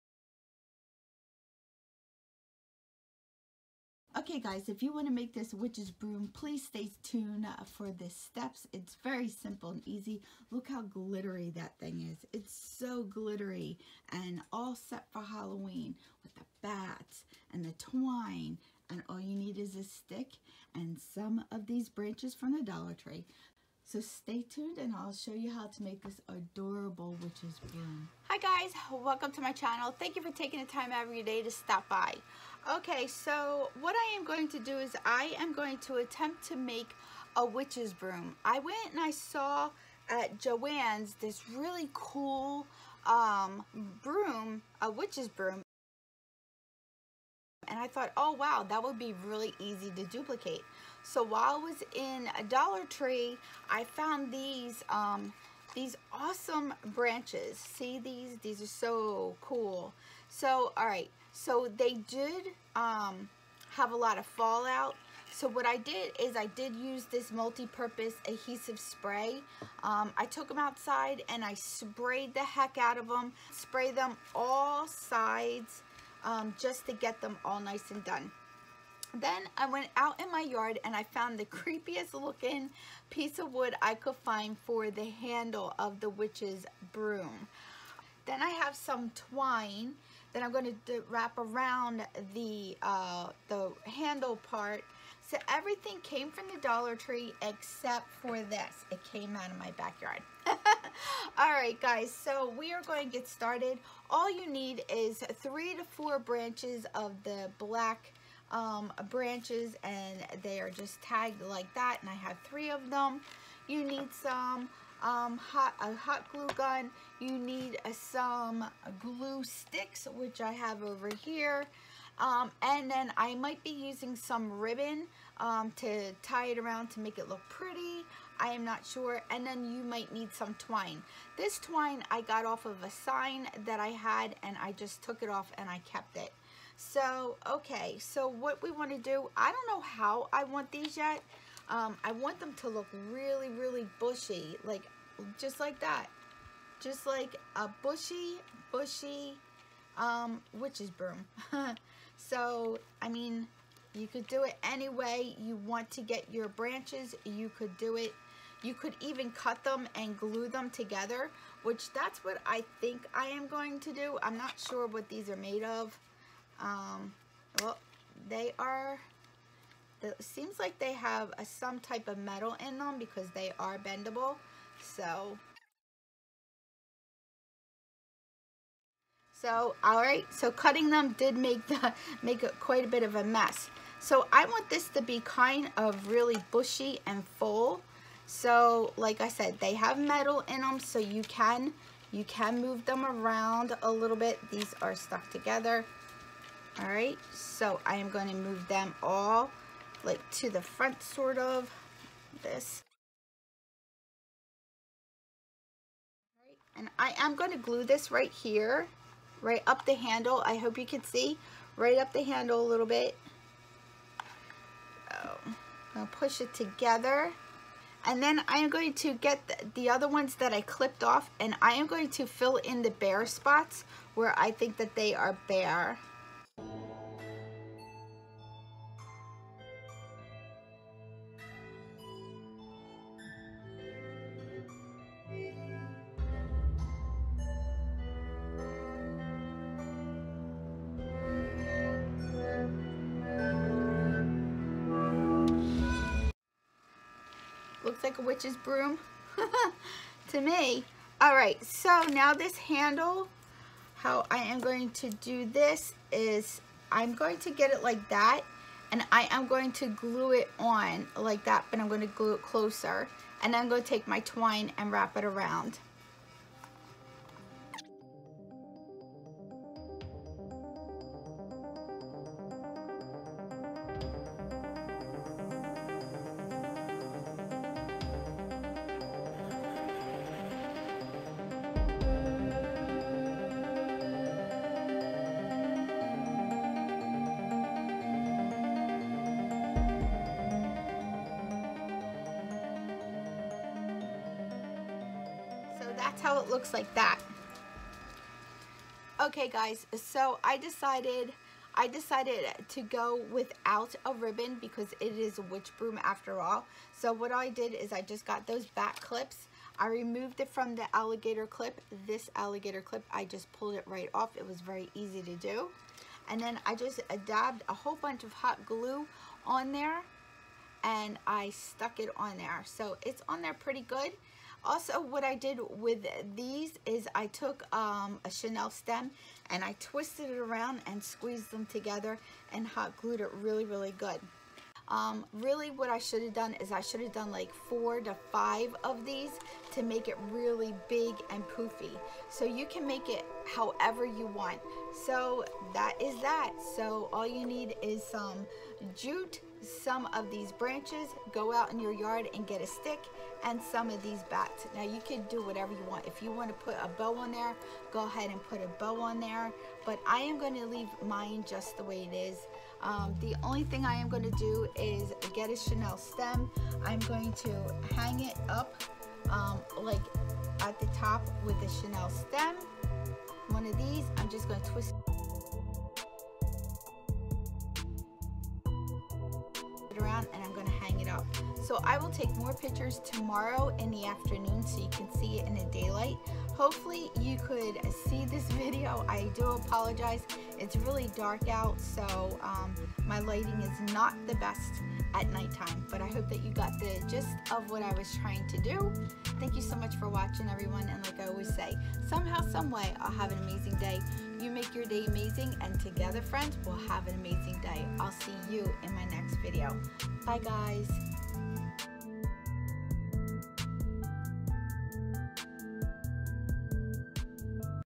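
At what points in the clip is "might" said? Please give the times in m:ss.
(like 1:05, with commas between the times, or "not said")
2:03, 2:09.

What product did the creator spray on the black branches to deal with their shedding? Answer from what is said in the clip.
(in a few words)
Multi-purpose adhesive spray.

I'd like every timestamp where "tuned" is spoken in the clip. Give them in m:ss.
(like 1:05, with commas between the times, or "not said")
0:07, 0:24.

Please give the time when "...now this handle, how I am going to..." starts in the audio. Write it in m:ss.
4:12.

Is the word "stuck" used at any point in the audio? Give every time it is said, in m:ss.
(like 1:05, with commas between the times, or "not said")
3:14, 5:21.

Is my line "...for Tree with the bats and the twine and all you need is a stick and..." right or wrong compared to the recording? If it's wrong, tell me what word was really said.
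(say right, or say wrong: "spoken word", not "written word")
wrong: "Halloween", not "Tree".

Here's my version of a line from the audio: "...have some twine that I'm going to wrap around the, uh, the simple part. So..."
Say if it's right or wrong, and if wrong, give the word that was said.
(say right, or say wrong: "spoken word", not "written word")
wrong: "handle", not "simple".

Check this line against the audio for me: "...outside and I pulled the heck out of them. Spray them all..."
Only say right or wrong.
wrong.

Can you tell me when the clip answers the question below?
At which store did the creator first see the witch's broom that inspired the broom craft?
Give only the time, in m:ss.
0:40.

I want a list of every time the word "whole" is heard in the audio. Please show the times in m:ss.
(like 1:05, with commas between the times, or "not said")
5:17.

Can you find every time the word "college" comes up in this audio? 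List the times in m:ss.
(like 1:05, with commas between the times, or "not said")
not said.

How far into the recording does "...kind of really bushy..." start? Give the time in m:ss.
3:05.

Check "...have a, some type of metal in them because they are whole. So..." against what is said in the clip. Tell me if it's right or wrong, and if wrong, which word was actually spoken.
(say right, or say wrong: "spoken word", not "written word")
wrong: "bendable", not "whole".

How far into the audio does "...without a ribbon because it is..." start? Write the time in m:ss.
5:03.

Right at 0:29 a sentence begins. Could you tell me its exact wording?
Thank you for taking the time every day to stop by.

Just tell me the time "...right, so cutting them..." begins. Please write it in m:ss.
3:00.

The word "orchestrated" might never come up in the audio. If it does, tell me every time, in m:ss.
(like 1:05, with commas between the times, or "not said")
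not said.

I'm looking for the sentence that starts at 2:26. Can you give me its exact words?
Just like a bushy, bushy um, witch's broom.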